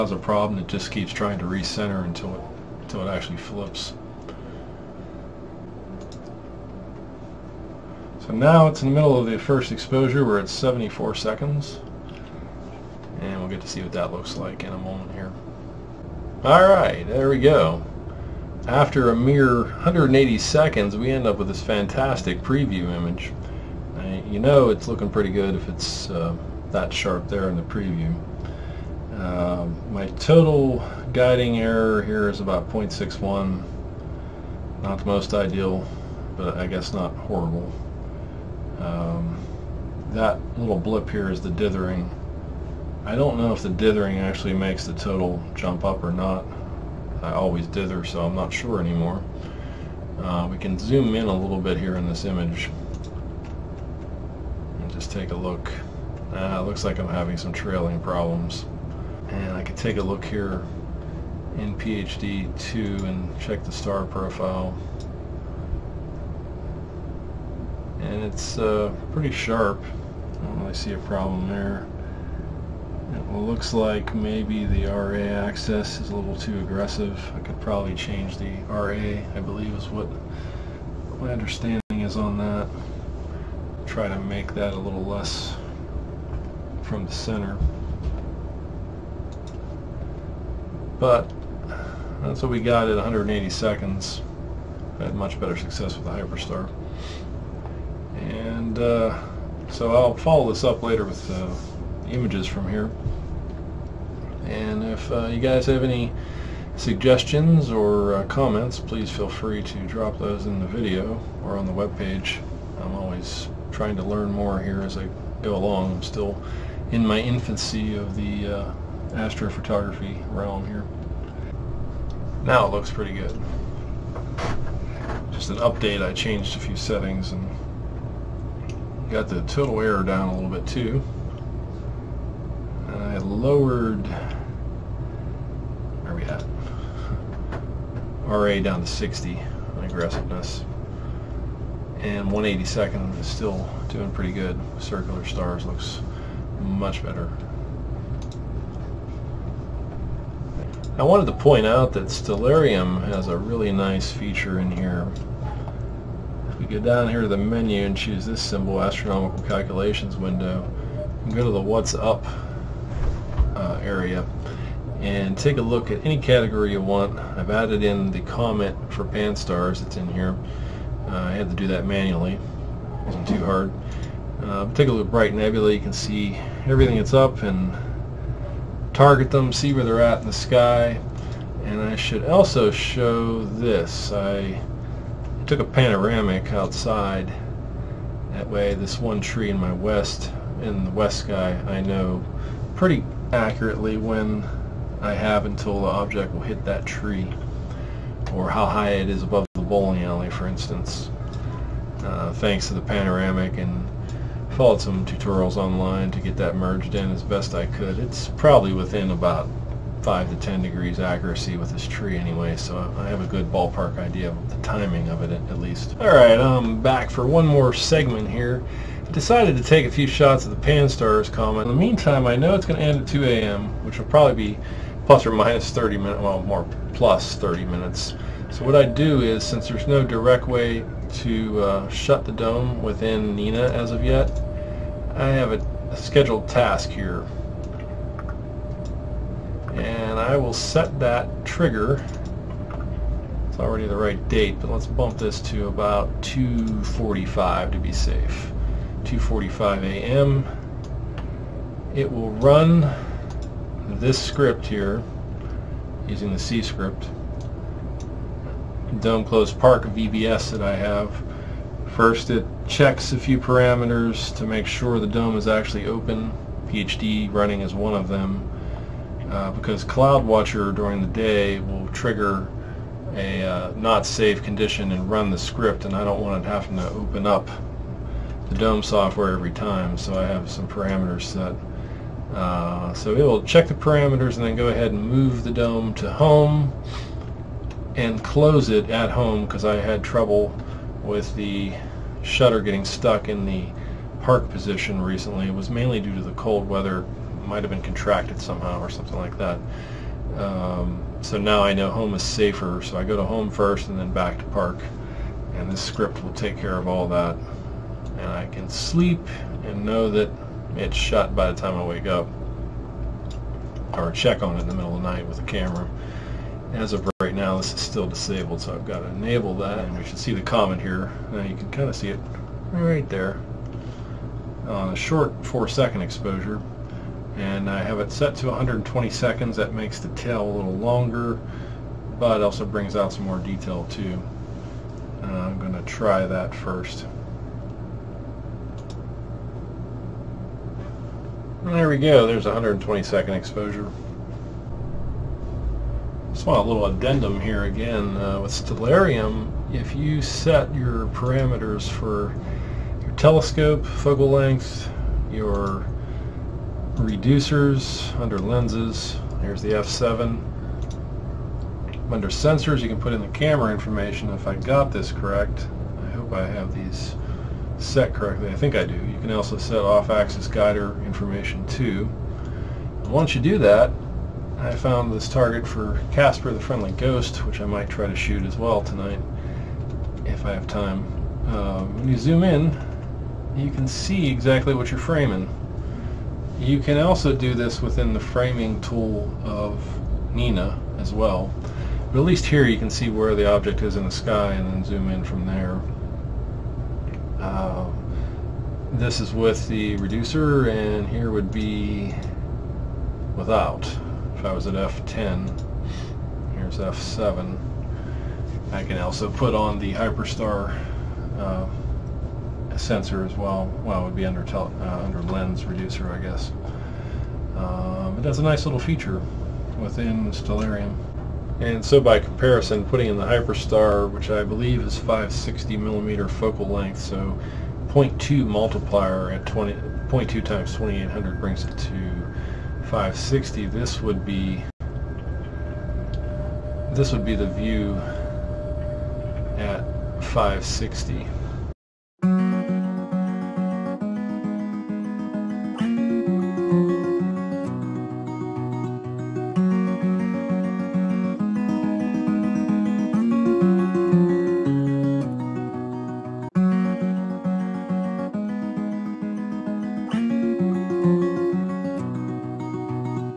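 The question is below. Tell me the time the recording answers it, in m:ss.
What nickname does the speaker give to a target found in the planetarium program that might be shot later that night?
6:16.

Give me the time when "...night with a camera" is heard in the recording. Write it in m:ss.
5:15.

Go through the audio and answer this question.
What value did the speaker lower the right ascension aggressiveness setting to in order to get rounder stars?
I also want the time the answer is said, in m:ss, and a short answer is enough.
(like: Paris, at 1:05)
60, at 2:18.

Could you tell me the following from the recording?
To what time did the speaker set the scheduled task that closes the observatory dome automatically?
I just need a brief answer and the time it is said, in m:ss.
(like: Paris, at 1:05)
2:45 a.m., at 4:09.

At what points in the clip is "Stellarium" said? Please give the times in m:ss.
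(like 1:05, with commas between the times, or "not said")
2:32, 5:48, 7:00.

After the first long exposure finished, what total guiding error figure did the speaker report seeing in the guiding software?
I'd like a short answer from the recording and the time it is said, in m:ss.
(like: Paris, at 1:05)
0.61, at 0:32.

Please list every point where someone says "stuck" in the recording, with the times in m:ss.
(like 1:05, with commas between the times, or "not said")
4:52.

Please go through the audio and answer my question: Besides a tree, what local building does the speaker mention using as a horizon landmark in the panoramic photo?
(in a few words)
bowling alley.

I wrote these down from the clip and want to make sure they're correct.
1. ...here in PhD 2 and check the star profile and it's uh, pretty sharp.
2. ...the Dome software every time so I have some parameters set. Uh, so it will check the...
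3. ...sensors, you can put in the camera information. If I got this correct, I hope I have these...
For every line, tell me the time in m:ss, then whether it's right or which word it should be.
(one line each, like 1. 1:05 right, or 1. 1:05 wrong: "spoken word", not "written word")
1. 1:00 right
2. 4:38 right
3. 6:02 right.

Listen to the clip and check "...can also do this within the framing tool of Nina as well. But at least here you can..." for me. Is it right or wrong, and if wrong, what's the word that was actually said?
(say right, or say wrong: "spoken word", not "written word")
right.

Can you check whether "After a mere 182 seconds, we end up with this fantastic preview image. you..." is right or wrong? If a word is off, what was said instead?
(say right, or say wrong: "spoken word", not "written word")
wrong: "180", not "182".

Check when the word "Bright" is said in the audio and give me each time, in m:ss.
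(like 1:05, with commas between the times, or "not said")
2:55.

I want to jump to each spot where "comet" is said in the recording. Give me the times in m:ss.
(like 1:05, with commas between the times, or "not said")
2:48, 3:41, 5:20.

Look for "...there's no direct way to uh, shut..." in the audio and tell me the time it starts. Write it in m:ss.
3:49.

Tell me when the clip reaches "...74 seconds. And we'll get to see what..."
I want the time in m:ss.
0:10.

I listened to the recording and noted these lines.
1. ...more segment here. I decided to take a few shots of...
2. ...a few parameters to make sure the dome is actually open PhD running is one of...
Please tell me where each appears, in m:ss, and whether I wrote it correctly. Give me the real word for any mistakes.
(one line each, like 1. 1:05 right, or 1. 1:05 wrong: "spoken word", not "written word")
1. 3:37 right
2. 4:23 right.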